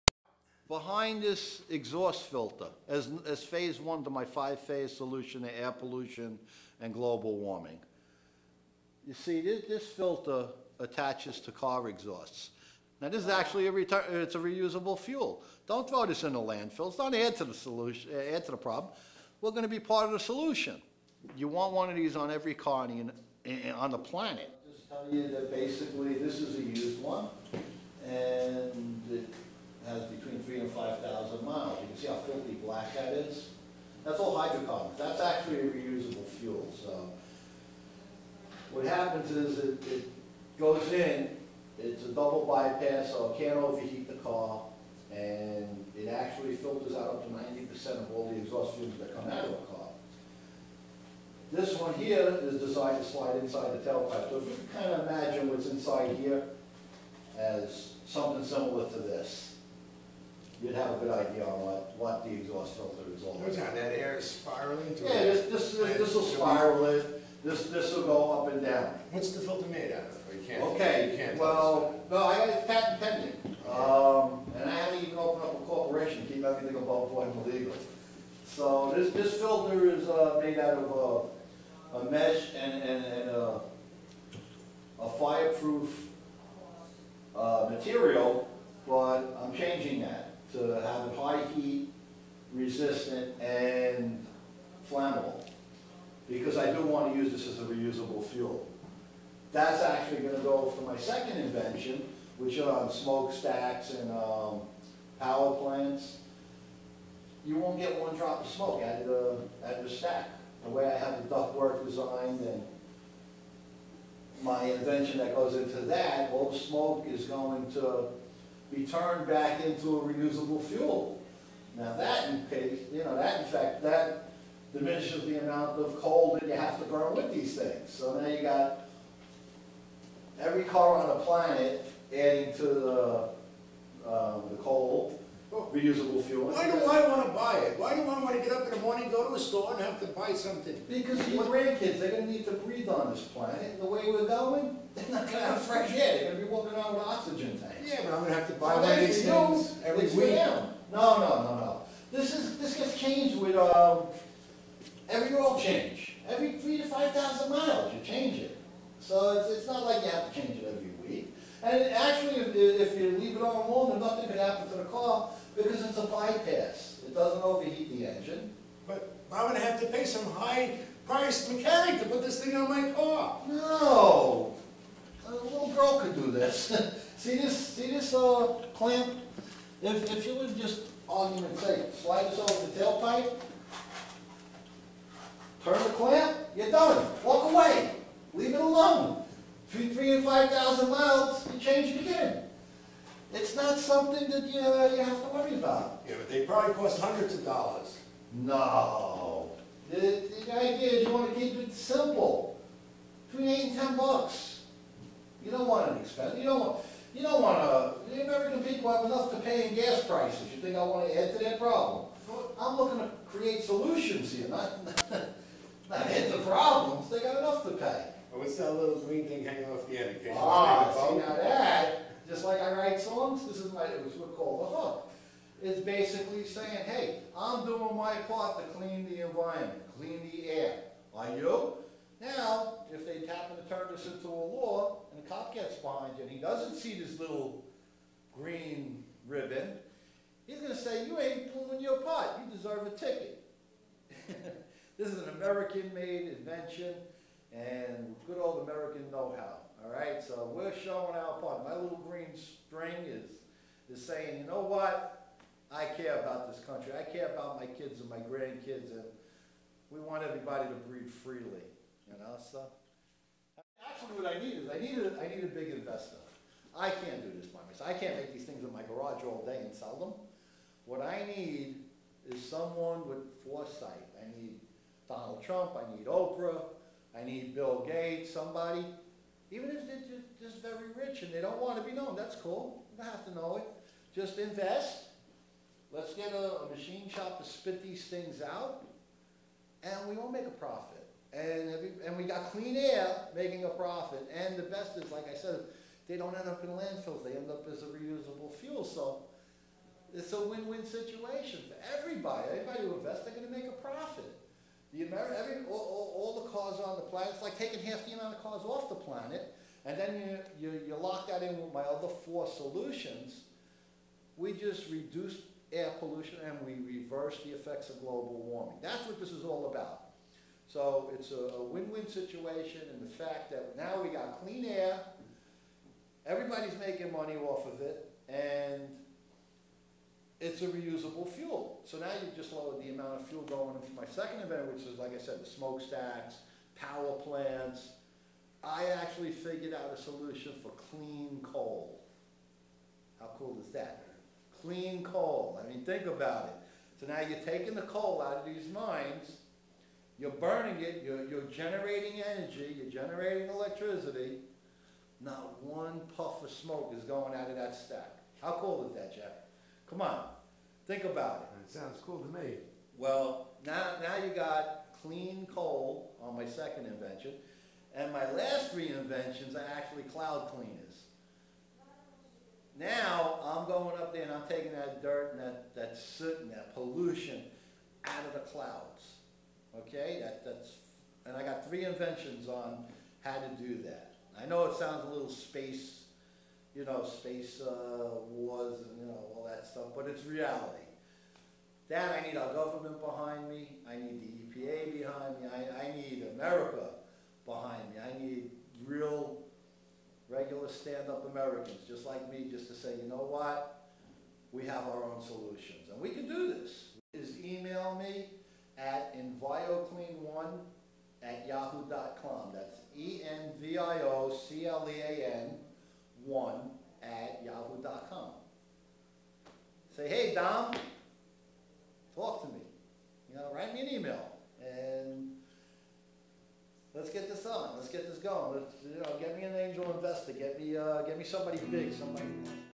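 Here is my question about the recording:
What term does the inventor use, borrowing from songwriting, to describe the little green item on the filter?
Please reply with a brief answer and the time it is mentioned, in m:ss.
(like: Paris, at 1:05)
the hook, at 3:44.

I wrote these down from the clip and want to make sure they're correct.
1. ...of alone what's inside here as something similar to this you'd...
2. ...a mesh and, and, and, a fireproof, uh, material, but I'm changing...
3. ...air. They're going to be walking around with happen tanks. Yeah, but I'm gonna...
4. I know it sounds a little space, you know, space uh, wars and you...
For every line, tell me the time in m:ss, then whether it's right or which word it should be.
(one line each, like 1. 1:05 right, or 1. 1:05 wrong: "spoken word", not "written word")
1. 0:54 wrong: "imagine", not "alone"
2. 1:21 right
3. 2:25 wrong: "oxygen", not "happen"
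4. 6:24 right.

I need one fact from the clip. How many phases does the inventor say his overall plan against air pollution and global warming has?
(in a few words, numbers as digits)
5.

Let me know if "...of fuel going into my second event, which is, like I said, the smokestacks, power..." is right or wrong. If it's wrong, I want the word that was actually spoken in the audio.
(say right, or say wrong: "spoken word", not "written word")
right.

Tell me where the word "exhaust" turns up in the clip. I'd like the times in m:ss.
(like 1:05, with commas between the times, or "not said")
0:01, 0:11, 0:48, 1:02.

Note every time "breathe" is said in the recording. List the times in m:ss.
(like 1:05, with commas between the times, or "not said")
2:22, 4:20.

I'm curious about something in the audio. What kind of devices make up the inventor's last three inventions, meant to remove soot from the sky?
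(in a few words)
cloud cleaners.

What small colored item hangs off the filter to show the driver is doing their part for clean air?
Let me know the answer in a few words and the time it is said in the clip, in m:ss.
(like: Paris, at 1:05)
green ribbon, at 3:58.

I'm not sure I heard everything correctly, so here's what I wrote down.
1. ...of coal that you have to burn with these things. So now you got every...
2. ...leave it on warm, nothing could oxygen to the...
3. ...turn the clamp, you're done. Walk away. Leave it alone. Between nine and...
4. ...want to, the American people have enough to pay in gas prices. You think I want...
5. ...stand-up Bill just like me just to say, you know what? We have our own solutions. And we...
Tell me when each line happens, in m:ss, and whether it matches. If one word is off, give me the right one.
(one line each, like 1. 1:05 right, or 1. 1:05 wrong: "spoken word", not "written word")
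1. 2:05 right
2. 2:43 wrong: "happen", not "oxygen"
3. 3:05 wrong: "three", not "nine"
4. 3:27 right
5. 6:40 wrong: "Americans", not "Bill".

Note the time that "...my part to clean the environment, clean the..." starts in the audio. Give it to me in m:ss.
3:47.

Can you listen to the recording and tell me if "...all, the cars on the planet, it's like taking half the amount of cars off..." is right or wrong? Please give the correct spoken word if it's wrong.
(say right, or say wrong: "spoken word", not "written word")
right.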